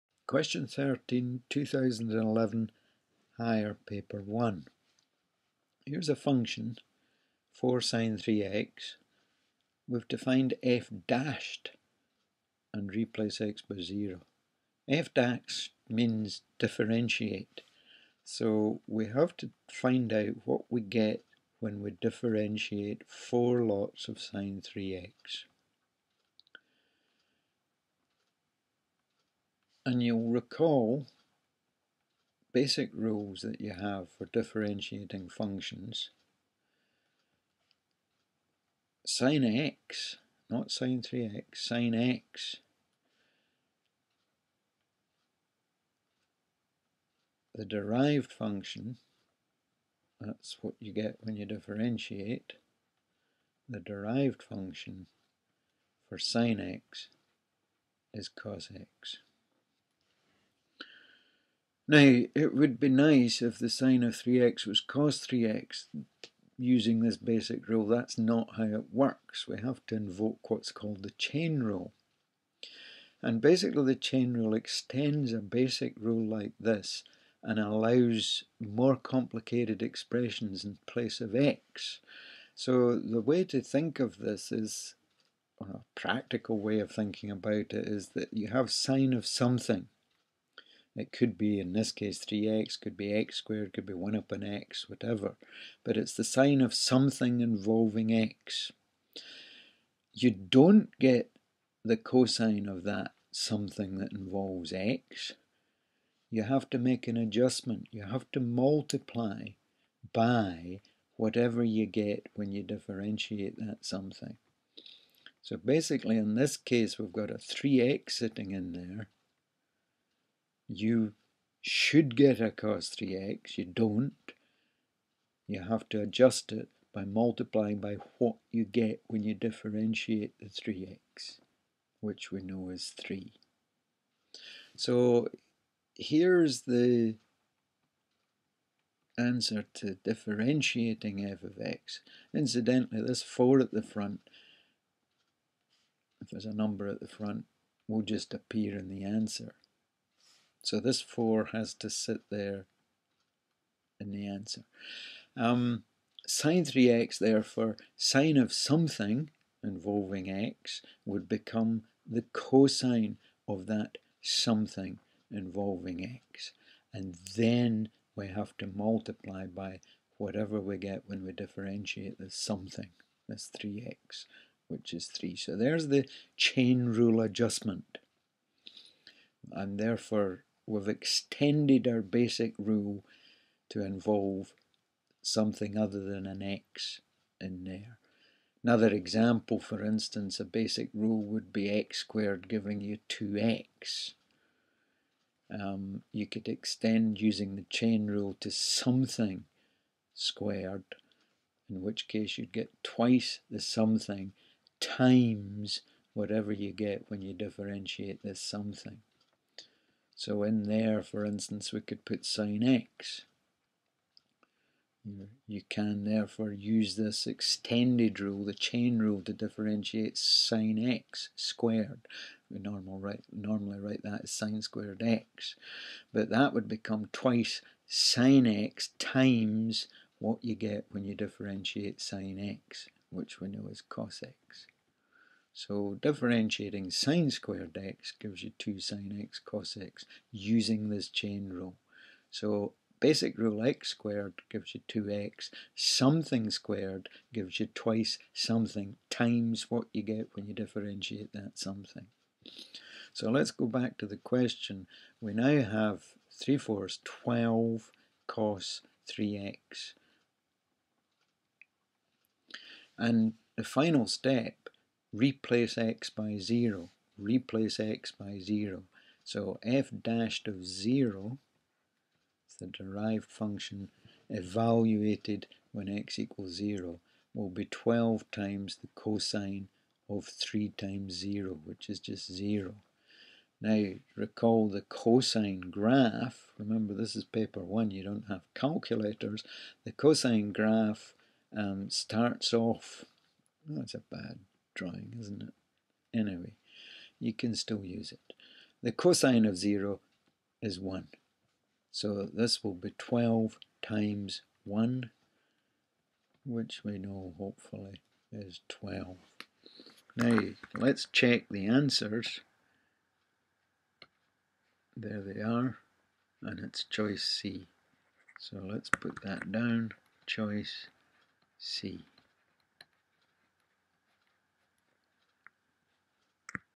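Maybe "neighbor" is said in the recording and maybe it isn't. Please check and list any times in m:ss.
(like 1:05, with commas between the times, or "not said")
not said.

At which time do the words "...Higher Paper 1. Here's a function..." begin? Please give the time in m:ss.
0:03.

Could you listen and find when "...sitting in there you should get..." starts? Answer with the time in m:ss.
1:58.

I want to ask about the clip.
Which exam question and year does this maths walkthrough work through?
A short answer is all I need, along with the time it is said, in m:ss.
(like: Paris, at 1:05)
Question 13, 2011, at 0:00.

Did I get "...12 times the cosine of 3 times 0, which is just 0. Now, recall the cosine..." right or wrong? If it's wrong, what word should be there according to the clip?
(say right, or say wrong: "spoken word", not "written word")
right.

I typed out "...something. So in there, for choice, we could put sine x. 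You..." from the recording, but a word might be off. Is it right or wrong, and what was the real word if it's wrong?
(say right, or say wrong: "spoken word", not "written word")
wrong: "instance", not "choice".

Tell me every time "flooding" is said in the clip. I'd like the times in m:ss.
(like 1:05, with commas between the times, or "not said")
not said.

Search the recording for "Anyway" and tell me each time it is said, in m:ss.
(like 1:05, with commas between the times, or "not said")
4:56.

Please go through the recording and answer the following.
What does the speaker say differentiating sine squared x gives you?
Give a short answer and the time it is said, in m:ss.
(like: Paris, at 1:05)
2 sine x cos x, at 3:58.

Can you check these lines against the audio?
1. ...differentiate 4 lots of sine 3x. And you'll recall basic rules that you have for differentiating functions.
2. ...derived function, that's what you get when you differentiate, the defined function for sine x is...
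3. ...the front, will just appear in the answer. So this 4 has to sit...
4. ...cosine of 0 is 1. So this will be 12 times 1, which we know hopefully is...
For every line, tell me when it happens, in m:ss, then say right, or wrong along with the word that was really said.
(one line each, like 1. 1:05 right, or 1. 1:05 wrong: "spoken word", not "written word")
1. 0:21 right
2. 0:47 wrong: "derived", not "defined"
3. 2:27 right
4. 4:58 right.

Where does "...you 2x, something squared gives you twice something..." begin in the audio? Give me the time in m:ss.
4:04.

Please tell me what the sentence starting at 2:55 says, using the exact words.
So there's the chain rule adjustment.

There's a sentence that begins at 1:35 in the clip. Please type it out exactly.
But it's the sine of something involving x.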